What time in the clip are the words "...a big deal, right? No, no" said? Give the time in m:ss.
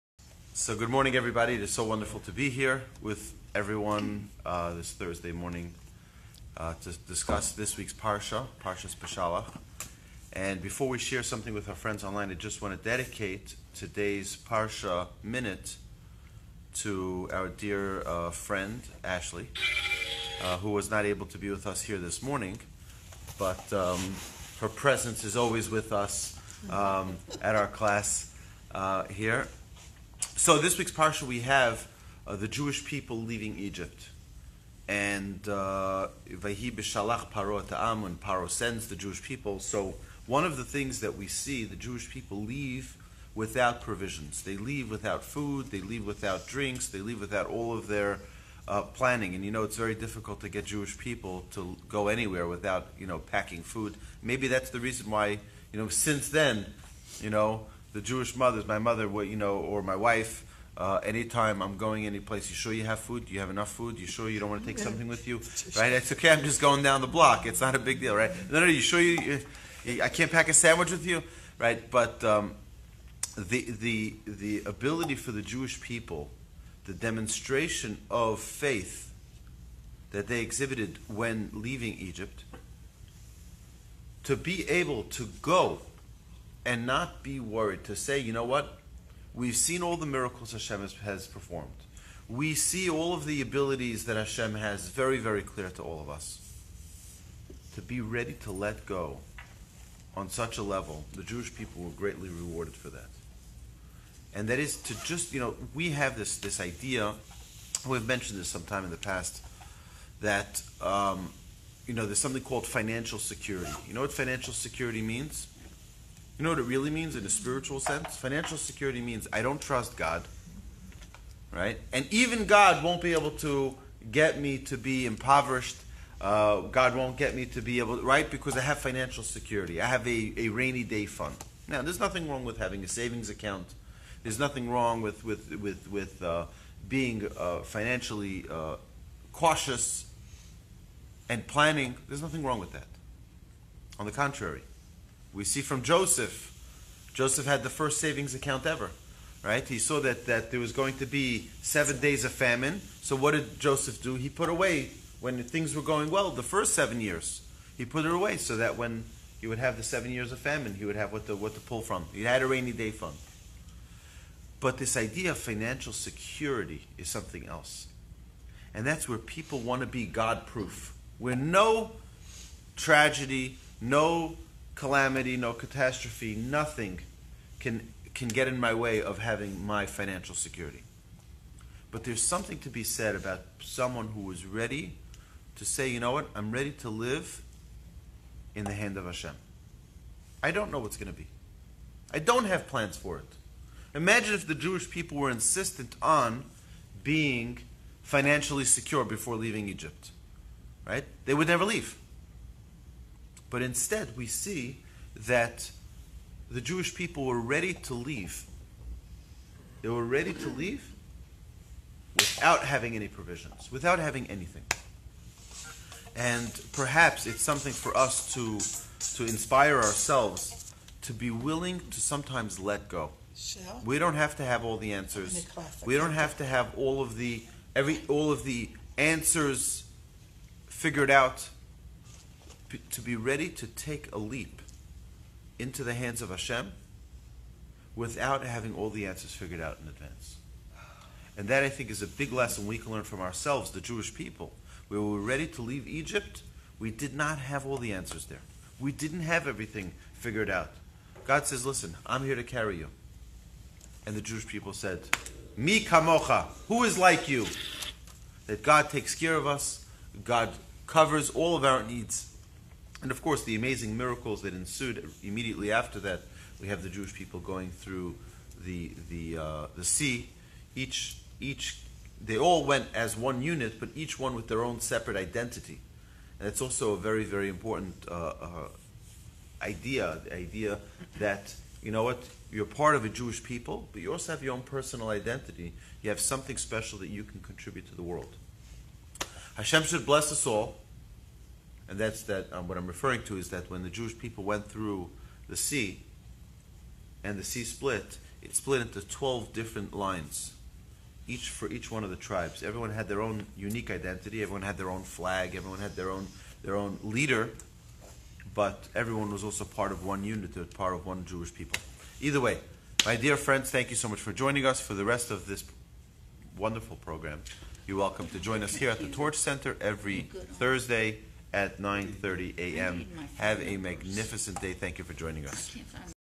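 1:07.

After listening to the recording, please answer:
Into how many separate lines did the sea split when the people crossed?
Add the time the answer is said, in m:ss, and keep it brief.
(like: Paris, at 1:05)
12, at 4:59.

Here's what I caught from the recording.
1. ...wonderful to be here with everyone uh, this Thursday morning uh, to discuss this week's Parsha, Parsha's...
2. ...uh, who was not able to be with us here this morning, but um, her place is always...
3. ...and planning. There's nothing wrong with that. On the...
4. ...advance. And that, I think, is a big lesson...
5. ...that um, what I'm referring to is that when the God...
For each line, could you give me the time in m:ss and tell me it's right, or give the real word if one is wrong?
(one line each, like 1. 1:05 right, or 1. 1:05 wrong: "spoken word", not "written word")
1. 0:01 right
2. 0:20 wrong: "presence", not "place"
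3. 2:21 right
4. 3:59 right
5. 4:52 wrong: "Jewish", not "God".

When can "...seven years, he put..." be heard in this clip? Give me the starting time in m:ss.
2:36.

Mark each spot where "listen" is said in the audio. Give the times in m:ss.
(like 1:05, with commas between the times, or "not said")
4:11.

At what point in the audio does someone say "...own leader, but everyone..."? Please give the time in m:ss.
5:06.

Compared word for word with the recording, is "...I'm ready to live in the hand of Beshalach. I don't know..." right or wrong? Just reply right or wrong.
wrong.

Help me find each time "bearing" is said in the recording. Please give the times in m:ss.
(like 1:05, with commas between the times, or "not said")
not said.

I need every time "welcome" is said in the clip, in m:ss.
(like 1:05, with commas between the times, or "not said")
5:17.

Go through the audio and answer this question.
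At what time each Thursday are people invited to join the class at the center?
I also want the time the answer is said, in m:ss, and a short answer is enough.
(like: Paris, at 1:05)
9:30 a.m., at 5:21.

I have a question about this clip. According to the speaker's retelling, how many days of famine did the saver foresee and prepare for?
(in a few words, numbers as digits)
7.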